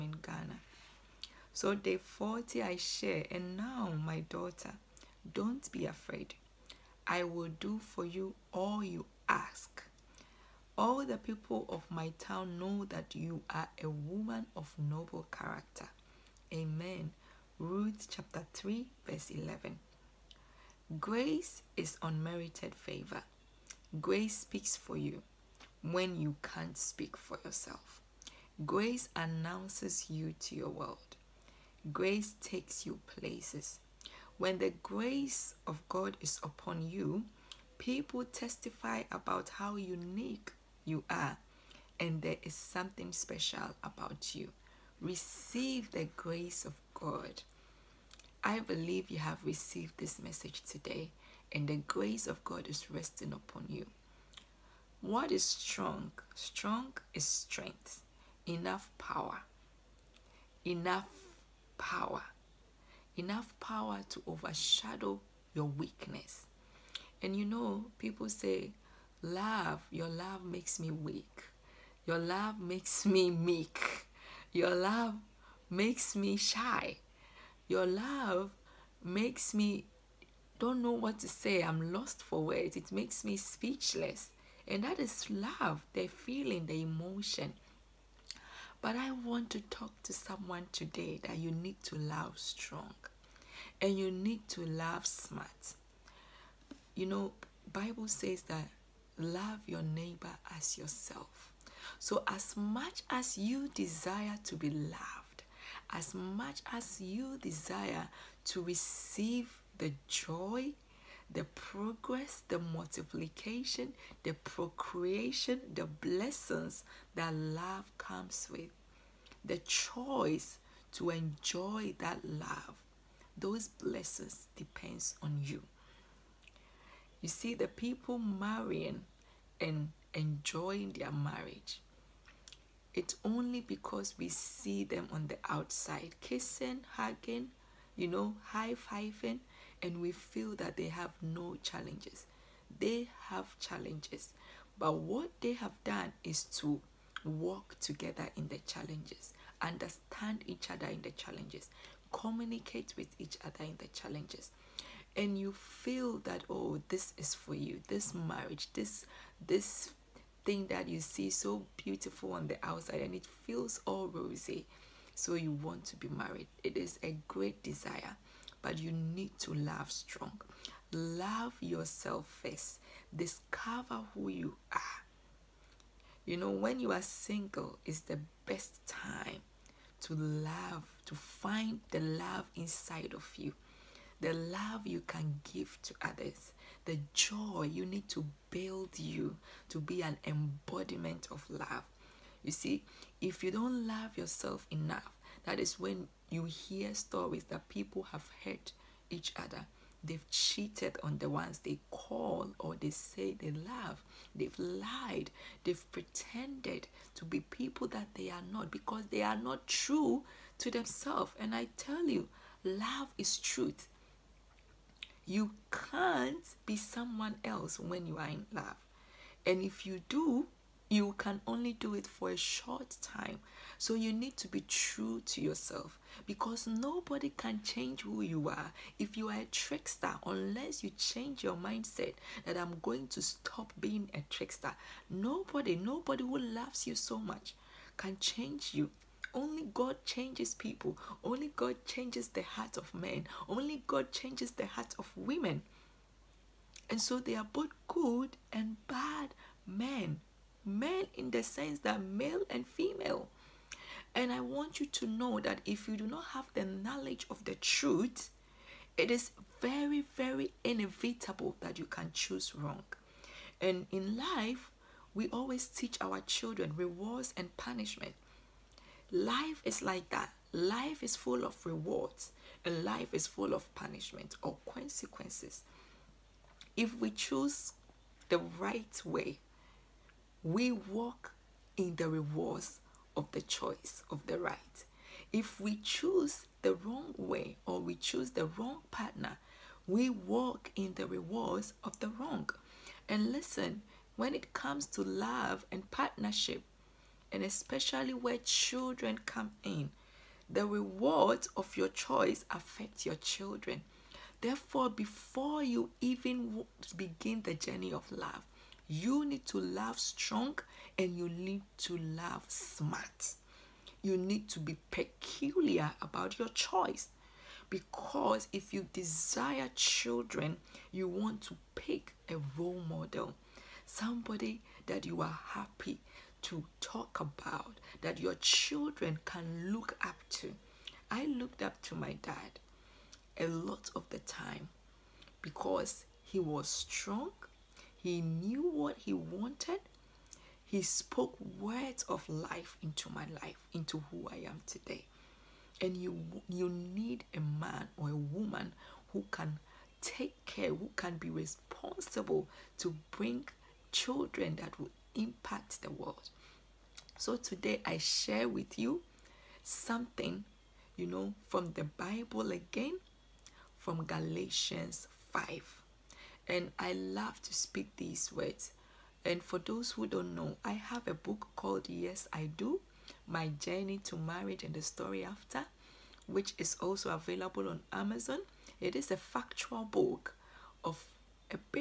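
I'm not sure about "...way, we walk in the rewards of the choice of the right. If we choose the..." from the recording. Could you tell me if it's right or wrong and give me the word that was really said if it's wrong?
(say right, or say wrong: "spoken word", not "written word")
right.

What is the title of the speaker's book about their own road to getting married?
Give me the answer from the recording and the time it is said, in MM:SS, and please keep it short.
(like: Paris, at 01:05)
Yes I Do, at 06:11.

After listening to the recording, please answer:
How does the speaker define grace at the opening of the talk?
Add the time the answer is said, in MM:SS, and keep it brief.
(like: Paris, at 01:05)
Unmerited favor, at 00:22.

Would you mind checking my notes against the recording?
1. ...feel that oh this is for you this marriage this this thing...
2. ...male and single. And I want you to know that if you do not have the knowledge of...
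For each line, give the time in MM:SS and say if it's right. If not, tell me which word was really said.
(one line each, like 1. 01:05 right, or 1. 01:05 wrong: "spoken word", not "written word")
1. 02:35 right
2. 04:12 wrong: "female", not "single".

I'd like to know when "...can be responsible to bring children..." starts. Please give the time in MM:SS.
05:50.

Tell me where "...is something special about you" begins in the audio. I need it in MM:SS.
00:42.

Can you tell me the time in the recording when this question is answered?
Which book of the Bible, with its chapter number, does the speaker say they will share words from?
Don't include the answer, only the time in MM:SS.
06:04.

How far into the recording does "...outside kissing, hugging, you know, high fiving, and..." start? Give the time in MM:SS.
02:15.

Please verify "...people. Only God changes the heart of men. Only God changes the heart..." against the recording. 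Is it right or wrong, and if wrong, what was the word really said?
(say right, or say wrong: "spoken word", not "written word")
right.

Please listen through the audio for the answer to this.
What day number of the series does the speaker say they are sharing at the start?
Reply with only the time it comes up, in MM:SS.
00:01.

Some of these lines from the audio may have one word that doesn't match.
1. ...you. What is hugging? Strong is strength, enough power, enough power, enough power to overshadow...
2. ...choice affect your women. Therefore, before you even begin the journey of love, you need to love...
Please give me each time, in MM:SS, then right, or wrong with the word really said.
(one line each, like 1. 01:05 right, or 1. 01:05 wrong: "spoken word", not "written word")
1. 00:53 wrong: "strong", not "hugging"
2. 05:01 wrong: "children", not "women".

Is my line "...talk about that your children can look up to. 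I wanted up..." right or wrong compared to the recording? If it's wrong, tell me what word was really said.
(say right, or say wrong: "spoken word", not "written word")
wrong: "looked", not "wanted".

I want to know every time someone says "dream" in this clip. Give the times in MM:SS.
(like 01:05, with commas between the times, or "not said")
not said.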